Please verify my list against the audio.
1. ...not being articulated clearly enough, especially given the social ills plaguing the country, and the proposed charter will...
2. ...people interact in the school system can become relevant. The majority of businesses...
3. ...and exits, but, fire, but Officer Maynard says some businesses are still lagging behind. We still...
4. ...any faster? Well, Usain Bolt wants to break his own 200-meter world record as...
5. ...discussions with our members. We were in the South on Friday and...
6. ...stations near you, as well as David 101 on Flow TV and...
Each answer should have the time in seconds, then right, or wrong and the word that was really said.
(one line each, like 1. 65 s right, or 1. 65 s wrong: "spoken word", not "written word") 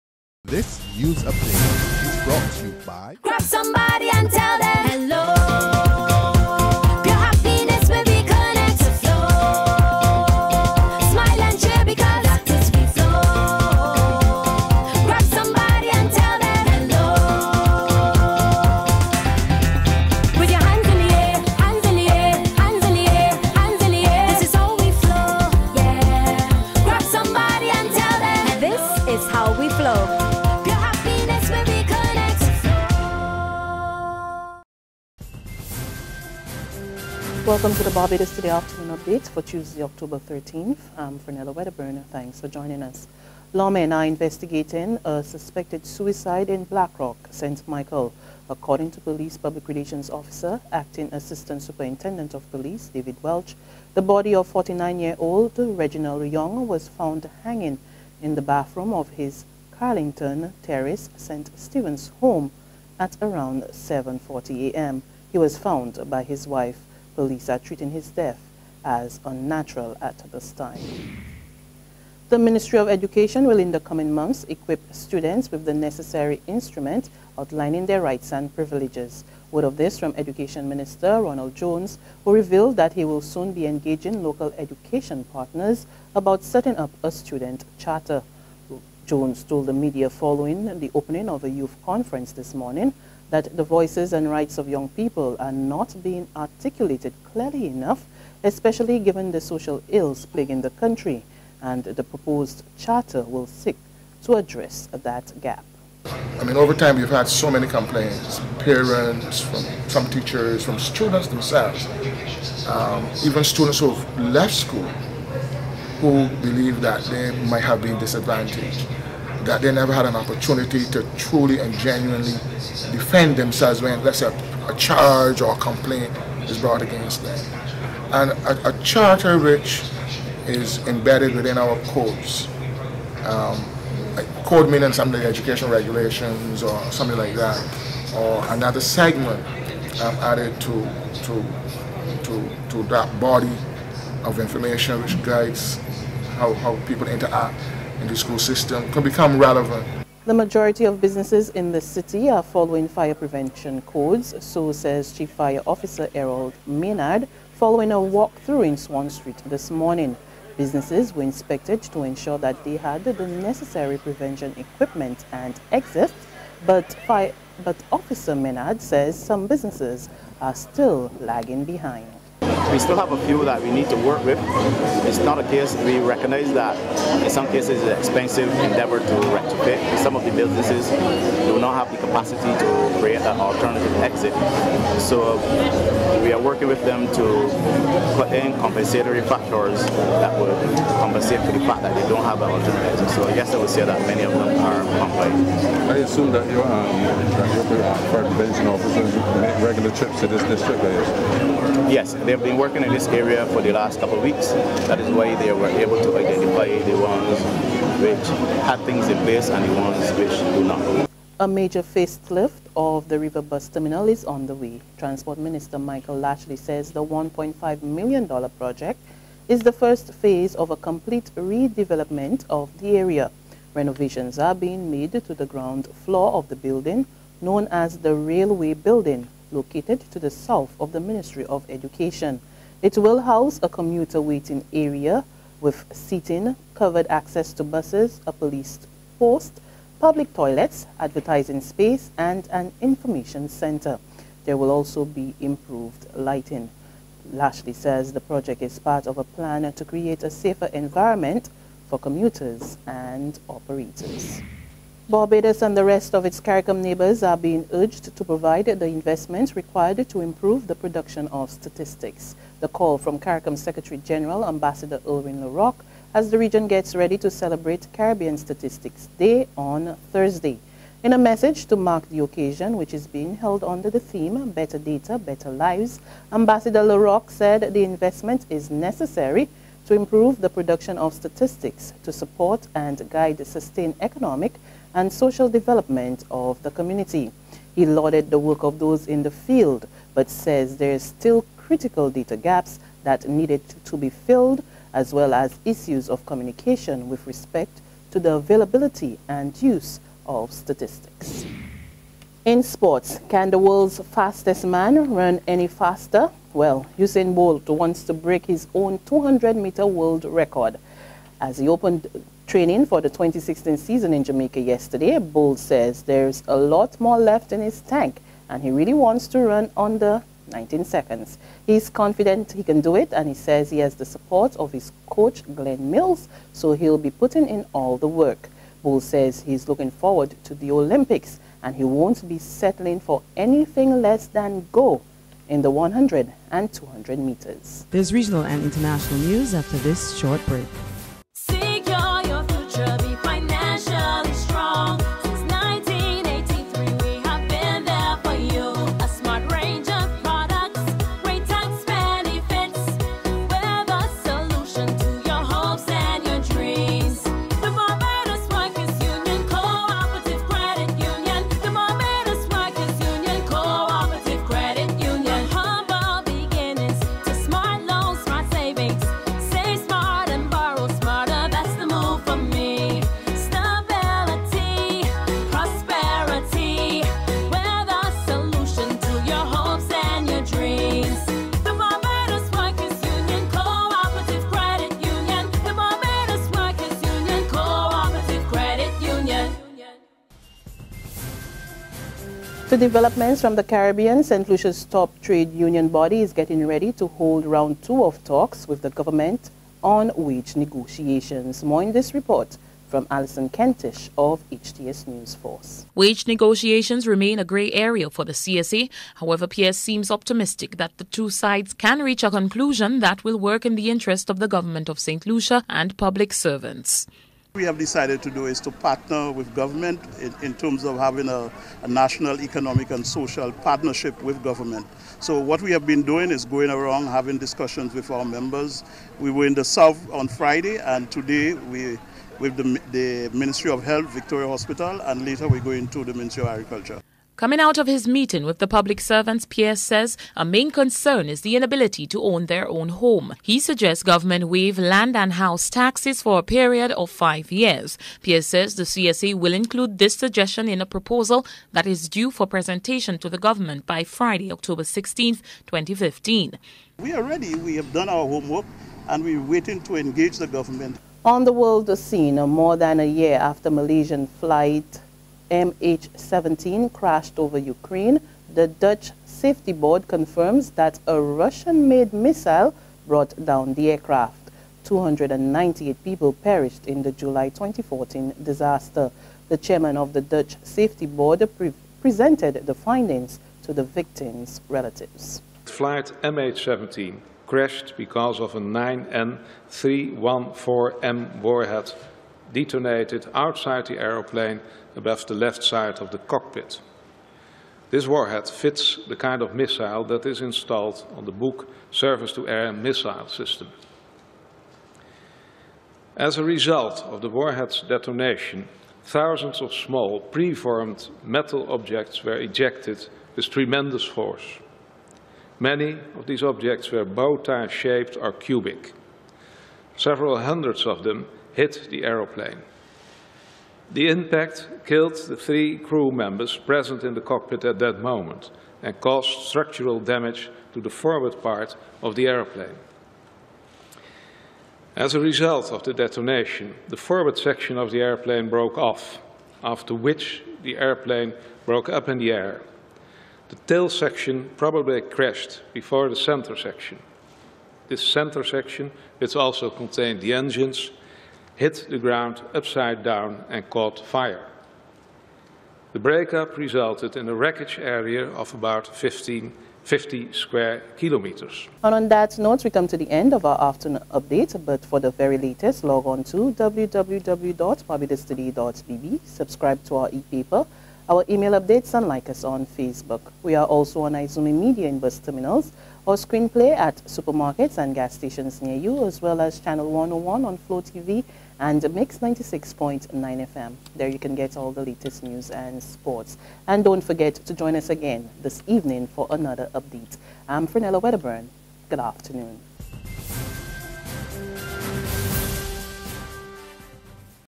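1. 95 s right
2. 146 s right
3. 165 s right
4. 305 s right
5. 427 s right
6. 578 s wrong: "Channel", not "David".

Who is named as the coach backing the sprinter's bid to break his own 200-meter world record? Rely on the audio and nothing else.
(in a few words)
Glenn Mills.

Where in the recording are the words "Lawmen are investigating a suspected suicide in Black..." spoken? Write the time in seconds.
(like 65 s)
43 s.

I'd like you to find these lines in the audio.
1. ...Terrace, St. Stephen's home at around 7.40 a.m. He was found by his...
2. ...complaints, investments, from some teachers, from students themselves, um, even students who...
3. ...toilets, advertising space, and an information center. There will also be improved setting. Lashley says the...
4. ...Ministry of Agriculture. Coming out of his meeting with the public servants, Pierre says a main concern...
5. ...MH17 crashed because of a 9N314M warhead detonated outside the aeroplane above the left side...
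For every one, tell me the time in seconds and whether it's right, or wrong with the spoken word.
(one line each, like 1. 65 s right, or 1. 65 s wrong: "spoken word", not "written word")
1. 60 s right
2. 107 s wrong: "parents", not "investments"
3. 240 s wrong: "lighting", not "setting"
4. 436 s right
5. 486 s right.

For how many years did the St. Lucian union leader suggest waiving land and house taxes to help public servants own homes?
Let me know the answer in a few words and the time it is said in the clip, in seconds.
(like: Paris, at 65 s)
5, at 447 s.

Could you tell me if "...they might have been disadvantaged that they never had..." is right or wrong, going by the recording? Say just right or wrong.
right.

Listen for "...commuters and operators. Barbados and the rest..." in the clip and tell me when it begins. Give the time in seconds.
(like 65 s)
251 s.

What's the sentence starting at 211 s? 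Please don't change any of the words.
A major facelift of the river bus terminal is on the way.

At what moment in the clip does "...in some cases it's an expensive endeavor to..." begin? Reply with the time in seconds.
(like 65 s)
177 s.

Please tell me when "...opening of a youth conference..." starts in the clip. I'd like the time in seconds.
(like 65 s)
90 s.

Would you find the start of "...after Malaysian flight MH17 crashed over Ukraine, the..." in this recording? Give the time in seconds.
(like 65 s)
463 s.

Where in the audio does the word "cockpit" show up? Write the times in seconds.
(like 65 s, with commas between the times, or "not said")
496 s, 527 s.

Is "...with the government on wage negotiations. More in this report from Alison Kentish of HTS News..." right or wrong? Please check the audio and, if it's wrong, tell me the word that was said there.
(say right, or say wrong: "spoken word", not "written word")
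right.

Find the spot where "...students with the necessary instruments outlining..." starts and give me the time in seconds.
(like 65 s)
74 s.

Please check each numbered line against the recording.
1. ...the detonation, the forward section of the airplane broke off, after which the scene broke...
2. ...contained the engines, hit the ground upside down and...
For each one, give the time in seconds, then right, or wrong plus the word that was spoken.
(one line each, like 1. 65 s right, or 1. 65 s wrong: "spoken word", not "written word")
1. 535 s wrong: "airplane", not "scene"
2. 549 s right.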